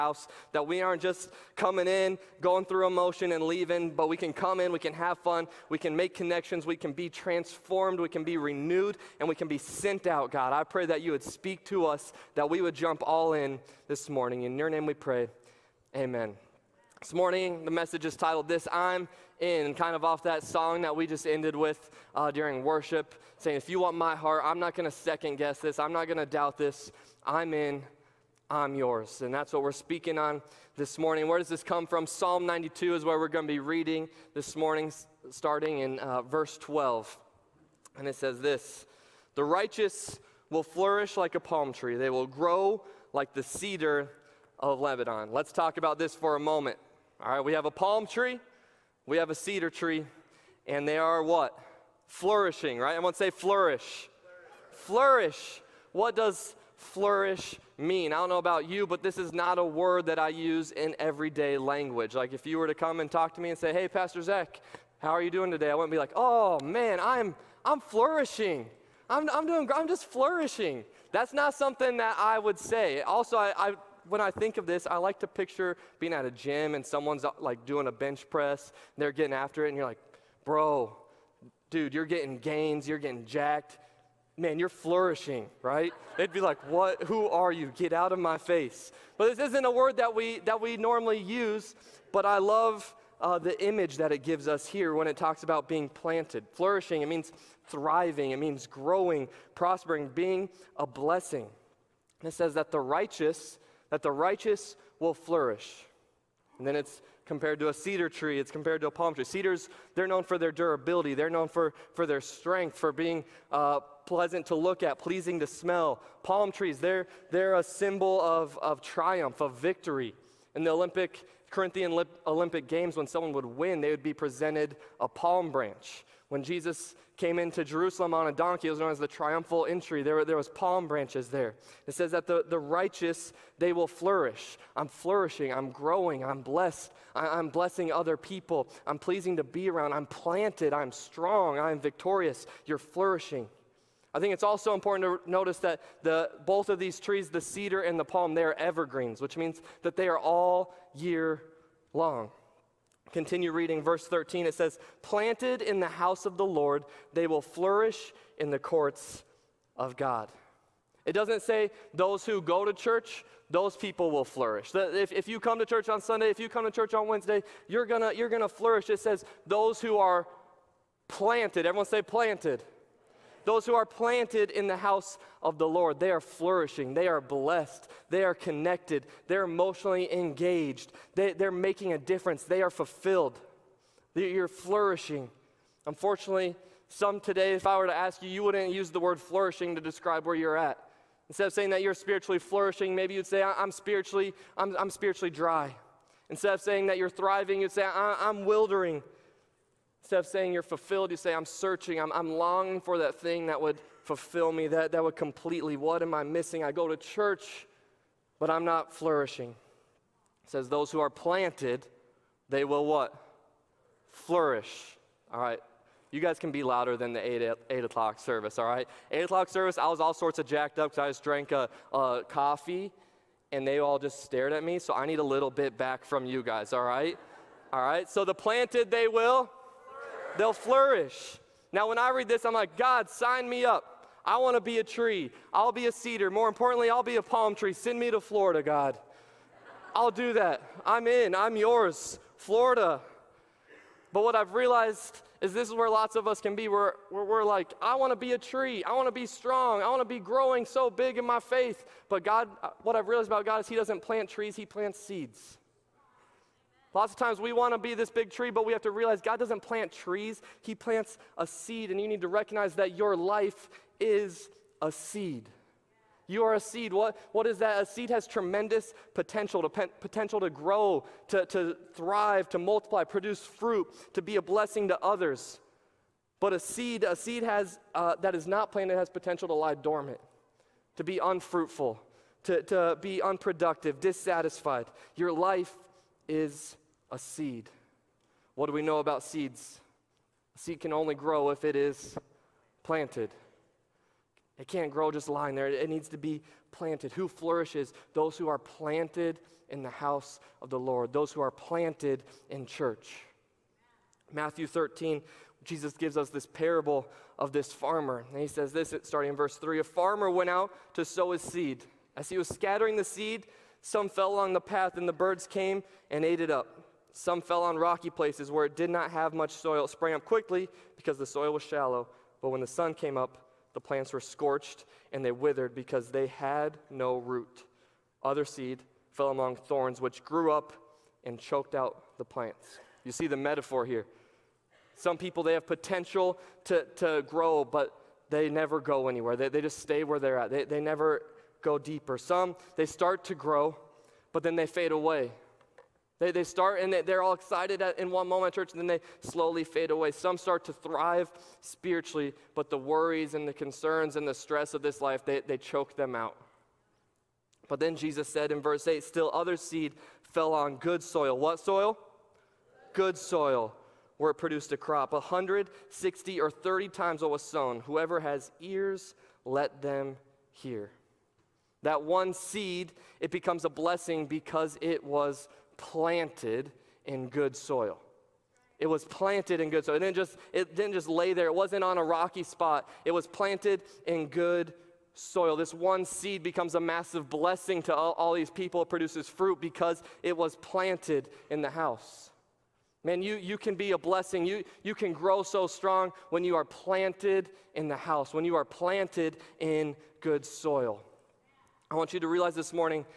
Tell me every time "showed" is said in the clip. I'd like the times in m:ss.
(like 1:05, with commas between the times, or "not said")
not said.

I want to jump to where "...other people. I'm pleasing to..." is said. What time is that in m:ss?
2:17.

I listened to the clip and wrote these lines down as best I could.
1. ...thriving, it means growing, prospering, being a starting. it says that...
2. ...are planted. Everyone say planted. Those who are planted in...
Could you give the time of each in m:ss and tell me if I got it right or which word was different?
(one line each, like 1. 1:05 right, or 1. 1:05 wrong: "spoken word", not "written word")
1. 1:37 wrong: "blessing", not "starting"
2. 2:49 right.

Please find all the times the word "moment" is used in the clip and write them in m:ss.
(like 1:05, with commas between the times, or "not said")
0:46, 5:48.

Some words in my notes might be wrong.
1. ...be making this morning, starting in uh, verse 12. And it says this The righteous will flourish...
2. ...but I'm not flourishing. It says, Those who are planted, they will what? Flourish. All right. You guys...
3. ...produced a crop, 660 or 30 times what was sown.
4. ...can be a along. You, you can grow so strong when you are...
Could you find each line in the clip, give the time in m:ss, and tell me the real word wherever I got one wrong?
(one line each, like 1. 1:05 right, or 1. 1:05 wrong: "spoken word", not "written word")
1. 0:33 wrong: "reading", not "making"
2. 3:28 right
3. 6:04 wrong: "160", not "660"
4. 6:33 wrong: "blessing", not "along".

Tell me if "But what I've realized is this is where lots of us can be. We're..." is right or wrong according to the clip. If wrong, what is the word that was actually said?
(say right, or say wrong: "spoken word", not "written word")
right.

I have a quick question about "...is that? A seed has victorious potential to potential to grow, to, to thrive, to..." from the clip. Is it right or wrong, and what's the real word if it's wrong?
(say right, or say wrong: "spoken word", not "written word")
wrong: "tremendous", not "victorious".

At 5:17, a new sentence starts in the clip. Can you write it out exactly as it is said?
Some fell on rocky places where it did not have much soil.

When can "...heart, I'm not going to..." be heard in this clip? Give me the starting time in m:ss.
0:24.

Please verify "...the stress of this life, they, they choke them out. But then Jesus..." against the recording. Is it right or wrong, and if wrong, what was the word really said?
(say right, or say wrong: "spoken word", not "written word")
right.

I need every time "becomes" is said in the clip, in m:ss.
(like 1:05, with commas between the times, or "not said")
6:13, 6:26.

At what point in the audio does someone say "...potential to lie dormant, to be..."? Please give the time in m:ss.
4:39.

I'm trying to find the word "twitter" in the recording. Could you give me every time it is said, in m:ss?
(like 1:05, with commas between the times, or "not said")
not said.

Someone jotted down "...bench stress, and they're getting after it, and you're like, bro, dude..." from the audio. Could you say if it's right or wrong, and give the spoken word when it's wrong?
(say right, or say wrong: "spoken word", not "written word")
wrong: "press", not "stress".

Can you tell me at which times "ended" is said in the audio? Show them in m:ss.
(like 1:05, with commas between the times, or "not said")
0:21.